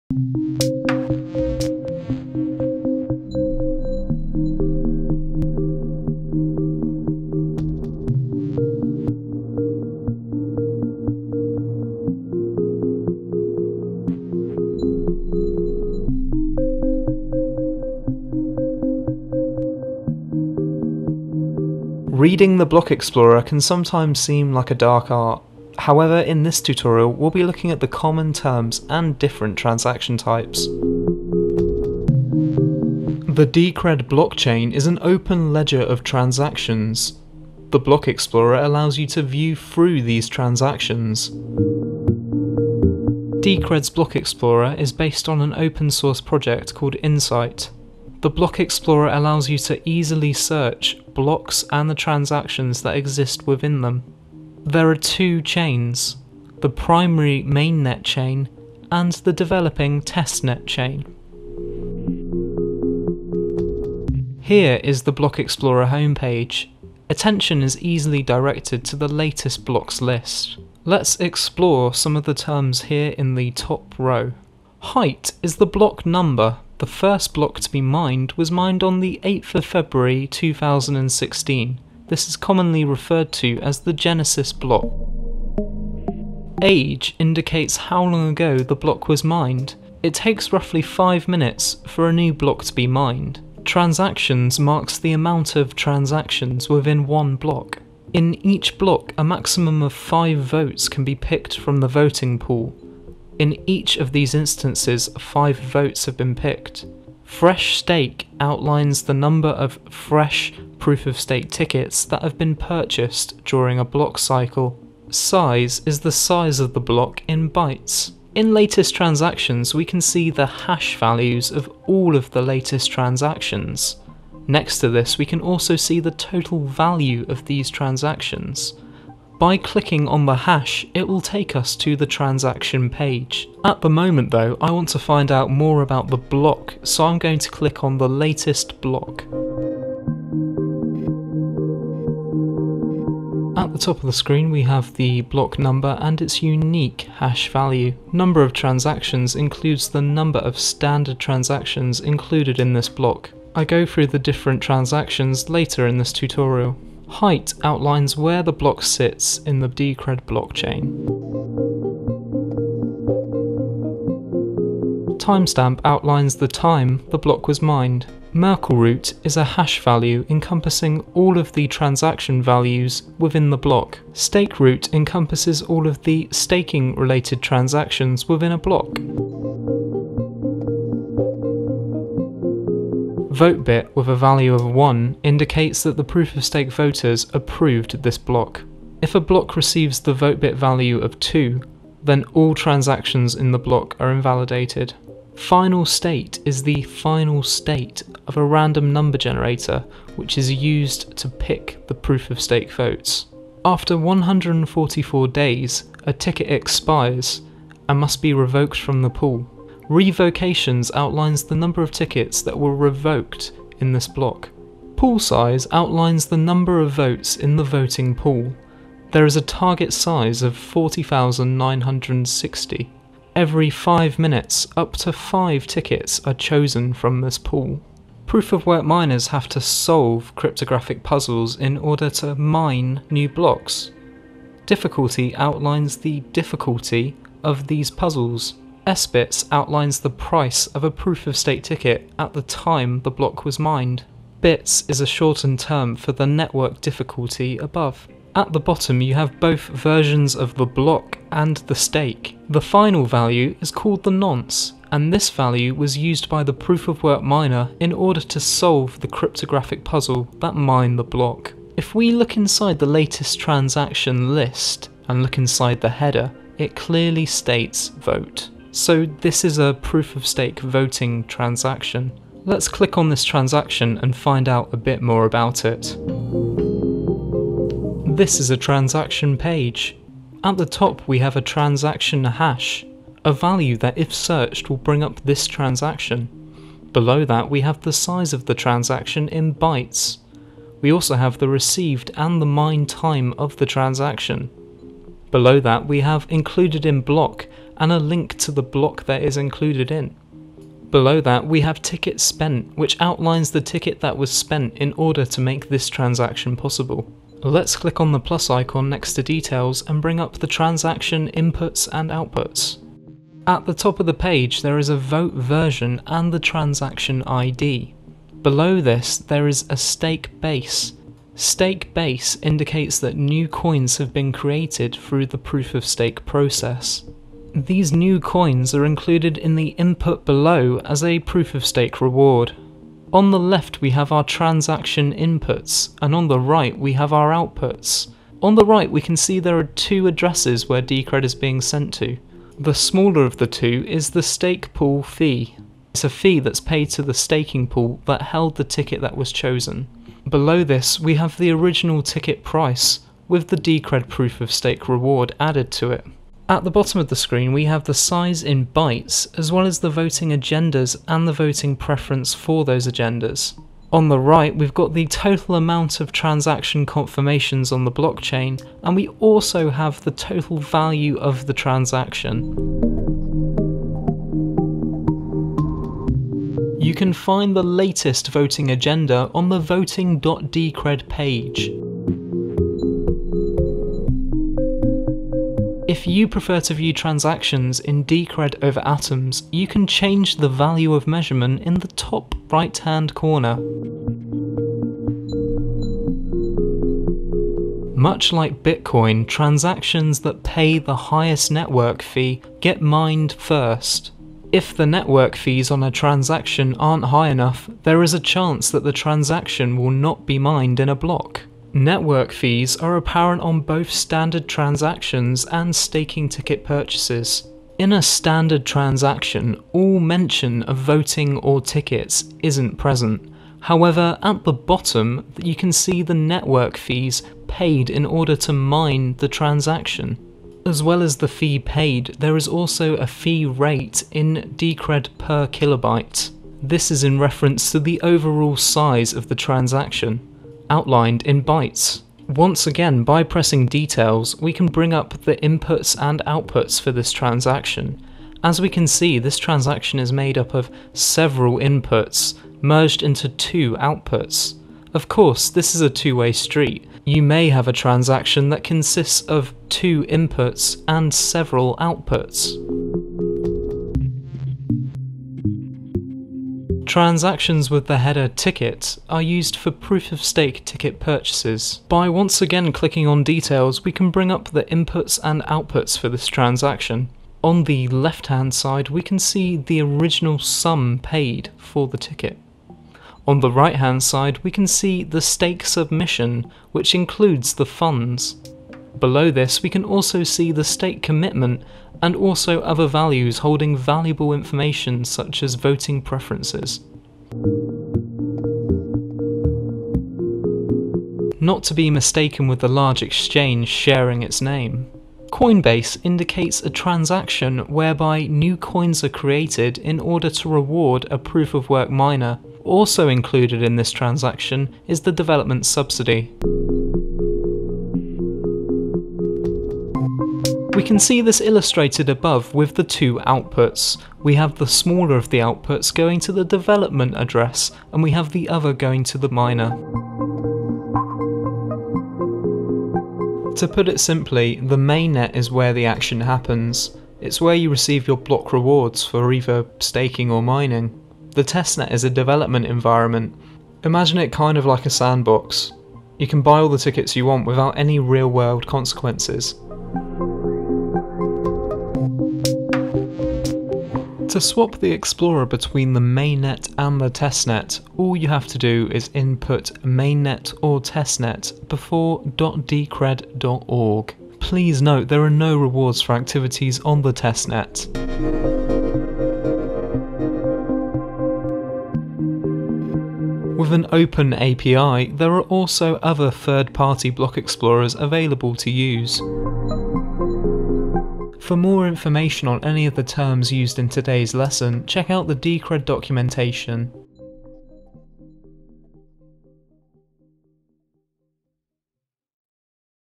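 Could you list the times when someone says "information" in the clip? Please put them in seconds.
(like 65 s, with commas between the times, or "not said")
494 s, 581 s.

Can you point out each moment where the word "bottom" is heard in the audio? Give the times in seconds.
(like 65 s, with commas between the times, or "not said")
248 s, 356 s, 424 s.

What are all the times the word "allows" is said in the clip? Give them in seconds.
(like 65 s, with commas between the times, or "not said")
38 s, 49 s.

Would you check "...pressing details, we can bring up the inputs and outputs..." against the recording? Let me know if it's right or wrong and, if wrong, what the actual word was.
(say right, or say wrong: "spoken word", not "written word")
right.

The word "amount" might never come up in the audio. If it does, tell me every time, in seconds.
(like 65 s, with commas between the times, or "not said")
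95 s, 365 s.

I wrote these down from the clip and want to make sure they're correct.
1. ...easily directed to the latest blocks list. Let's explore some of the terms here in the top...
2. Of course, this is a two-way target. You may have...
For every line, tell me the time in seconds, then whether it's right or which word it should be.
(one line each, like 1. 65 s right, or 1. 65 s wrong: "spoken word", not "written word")
1. 67 s right
2. 454 s wrong: "street", not "target".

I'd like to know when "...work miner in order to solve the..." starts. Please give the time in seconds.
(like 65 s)
257 s.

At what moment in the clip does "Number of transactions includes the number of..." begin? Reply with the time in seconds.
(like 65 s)
148 s.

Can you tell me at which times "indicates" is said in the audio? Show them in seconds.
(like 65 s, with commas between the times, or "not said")
87 s, 185 s, 322 s, 506 s.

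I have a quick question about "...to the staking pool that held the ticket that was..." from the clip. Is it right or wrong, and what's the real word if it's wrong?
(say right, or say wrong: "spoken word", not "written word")
right.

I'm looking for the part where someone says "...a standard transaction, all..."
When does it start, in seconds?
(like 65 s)
417 s.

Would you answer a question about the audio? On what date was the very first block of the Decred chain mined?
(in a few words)
8 February 2016.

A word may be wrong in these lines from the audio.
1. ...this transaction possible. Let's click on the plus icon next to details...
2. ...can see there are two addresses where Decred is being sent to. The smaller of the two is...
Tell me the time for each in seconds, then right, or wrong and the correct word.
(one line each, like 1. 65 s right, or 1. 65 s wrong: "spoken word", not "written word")
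1. 305 s right
2. 339 s right.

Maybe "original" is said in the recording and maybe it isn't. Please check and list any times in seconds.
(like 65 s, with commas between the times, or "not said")
351 s, 479 s.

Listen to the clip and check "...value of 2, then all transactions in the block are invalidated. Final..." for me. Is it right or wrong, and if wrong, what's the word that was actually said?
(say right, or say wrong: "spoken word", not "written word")
right.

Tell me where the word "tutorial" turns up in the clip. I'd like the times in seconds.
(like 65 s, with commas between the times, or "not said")
26 s, 156 s.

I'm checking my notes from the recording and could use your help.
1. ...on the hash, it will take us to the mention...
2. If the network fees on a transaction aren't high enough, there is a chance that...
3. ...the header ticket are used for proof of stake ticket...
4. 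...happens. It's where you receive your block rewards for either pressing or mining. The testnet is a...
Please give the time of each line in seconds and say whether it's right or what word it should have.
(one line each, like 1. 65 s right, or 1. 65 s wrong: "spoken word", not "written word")
1. 130 s wrong: "transaction", not "mention"
2. 404 s right
3. 467 s right
4. 536 s wrong: "staking", not "pressing".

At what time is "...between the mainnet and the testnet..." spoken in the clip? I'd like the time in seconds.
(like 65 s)
555 s.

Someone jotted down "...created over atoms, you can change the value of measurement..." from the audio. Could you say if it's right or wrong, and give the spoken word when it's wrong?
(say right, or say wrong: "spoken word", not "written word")
wrong: "decred", not "created".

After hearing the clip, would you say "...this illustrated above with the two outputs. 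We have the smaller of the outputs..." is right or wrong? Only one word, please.
right.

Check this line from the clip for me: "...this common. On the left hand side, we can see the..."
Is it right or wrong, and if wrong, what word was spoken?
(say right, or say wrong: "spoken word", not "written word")
wrong: "transaction", not "common".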